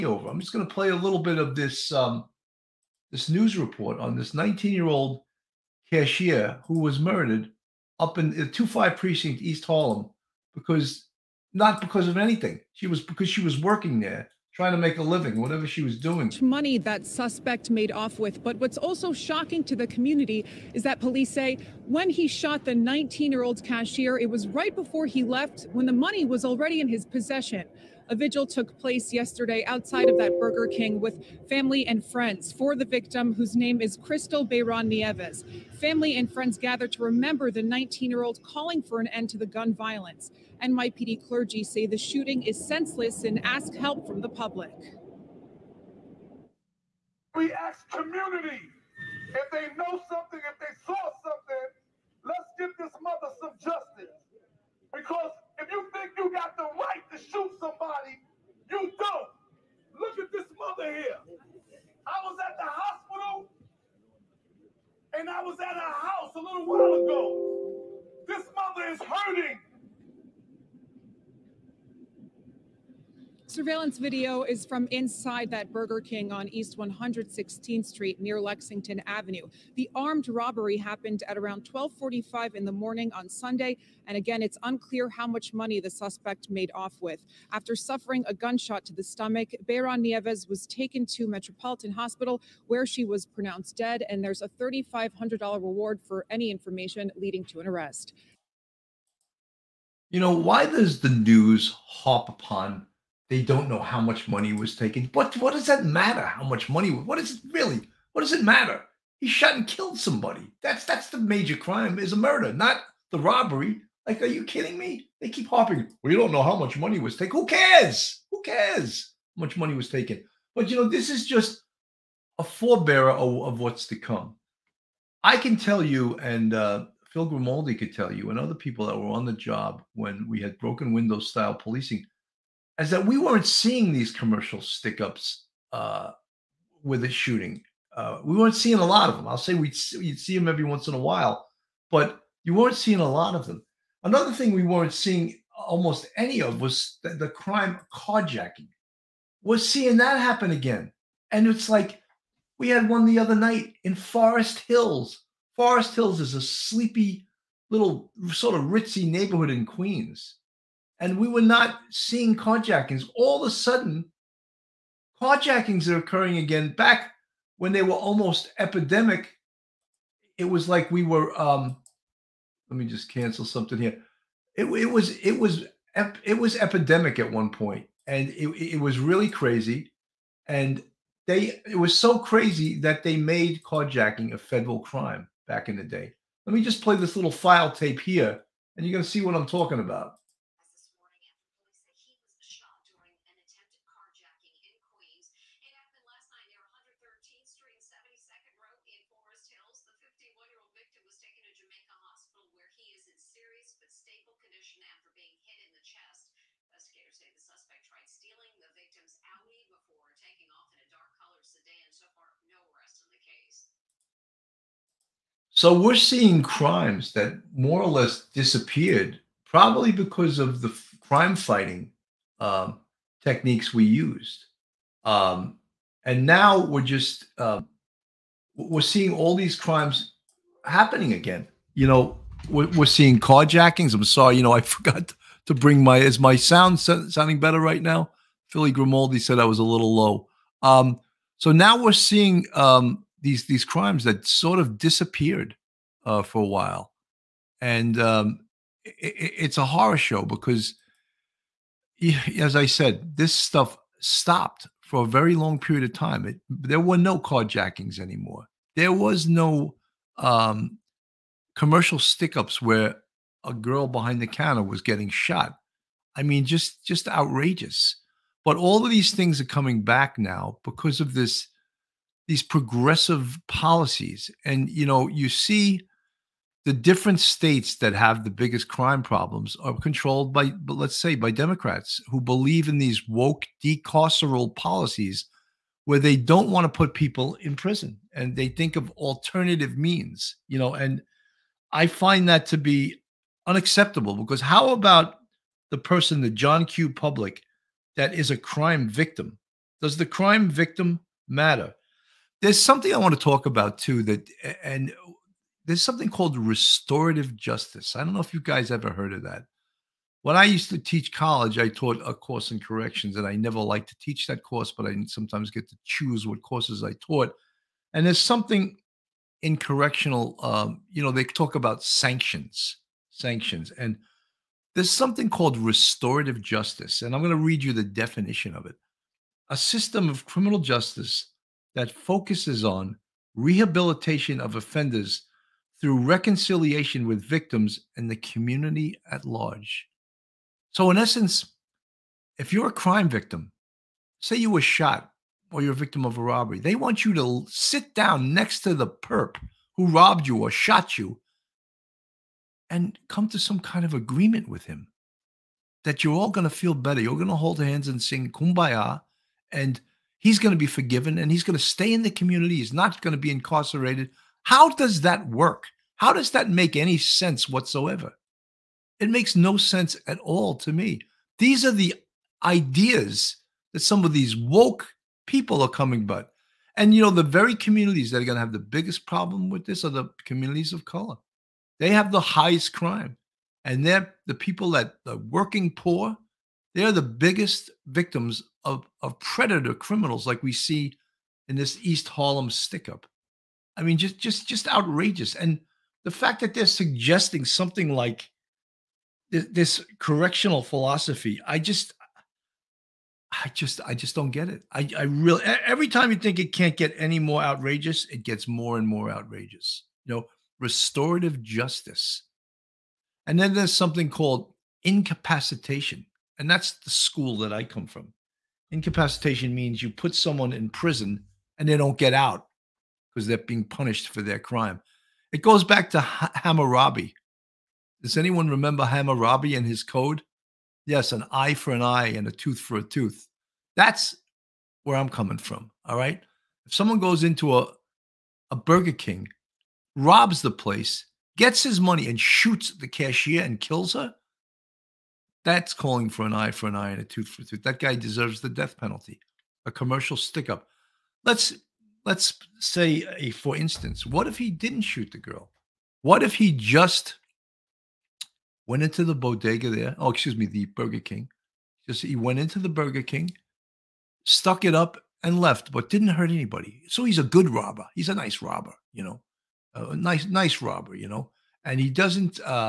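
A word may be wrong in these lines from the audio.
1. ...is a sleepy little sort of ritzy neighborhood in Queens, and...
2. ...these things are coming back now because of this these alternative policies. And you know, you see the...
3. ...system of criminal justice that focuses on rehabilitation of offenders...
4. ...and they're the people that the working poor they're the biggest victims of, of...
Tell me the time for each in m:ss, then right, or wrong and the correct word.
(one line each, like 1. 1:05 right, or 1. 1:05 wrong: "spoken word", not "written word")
1. 2:36 right
2. 4:28 wrong: "progressive", not "alternative"
3. 5:29 right
4. 6:23 right.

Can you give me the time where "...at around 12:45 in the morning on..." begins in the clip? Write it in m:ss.
1:21.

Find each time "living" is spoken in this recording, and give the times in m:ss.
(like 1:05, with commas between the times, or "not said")
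0:15.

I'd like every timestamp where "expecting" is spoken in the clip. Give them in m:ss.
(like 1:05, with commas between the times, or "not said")
not said.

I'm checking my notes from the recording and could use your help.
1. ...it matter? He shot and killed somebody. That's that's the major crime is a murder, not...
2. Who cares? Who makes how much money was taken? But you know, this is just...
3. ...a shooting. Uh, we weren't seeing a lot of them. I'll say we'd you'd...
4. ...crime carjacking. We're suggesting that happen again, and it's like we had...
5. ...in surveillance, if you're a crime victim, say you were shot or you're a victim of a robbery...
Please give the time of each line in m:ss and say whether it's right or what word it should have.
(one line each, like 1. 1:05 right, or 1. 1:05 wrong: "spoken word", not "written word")
1. 1:48 right
2. 1:57 wrong: "cares", not "makes"
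3. 2:17 right
4. 2:27 wrong: "seeing", not "suggesting"
5. 5:40 wrong: "essence", not "surveillance".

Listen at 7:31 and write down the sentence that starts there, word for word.
Let's let's say a for instance, what if he didn't shoot the girl?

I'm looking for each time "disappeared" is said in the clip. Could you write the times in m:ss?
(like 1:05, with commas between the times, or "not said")
3:38, 4:04.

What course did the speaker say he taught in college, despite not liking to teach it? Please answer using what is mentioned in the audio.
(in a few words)
corrections.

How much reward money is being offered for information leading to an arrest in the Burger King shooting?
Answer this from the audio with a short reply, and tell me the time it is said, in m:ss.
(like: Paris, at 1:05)
$3500, at 1:34.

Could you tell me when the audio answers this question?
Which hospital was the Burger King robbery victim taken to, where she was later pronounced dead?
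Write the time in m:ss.
1:31.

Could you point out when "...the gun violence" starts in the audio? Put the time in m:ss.
0:39.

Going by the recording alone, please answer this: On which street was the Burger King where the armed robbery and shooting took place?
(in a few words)
East 116th Street.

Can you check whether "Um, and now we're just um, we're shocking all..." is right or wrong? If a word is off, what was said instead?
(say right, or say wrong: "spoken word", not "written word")
wrong: "seeing", not "shocking".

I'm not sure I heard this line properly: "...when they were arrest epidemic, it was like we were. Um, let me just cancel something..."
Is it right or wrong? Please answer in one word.
wrong.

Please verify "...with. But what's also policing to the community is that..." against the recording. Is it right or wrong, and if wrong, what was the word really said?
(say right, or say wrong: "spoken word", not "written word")
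wrong: "shocking", not "policing".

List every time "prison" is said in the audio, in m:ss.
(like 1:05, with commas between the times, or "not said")
4:47, 7:00.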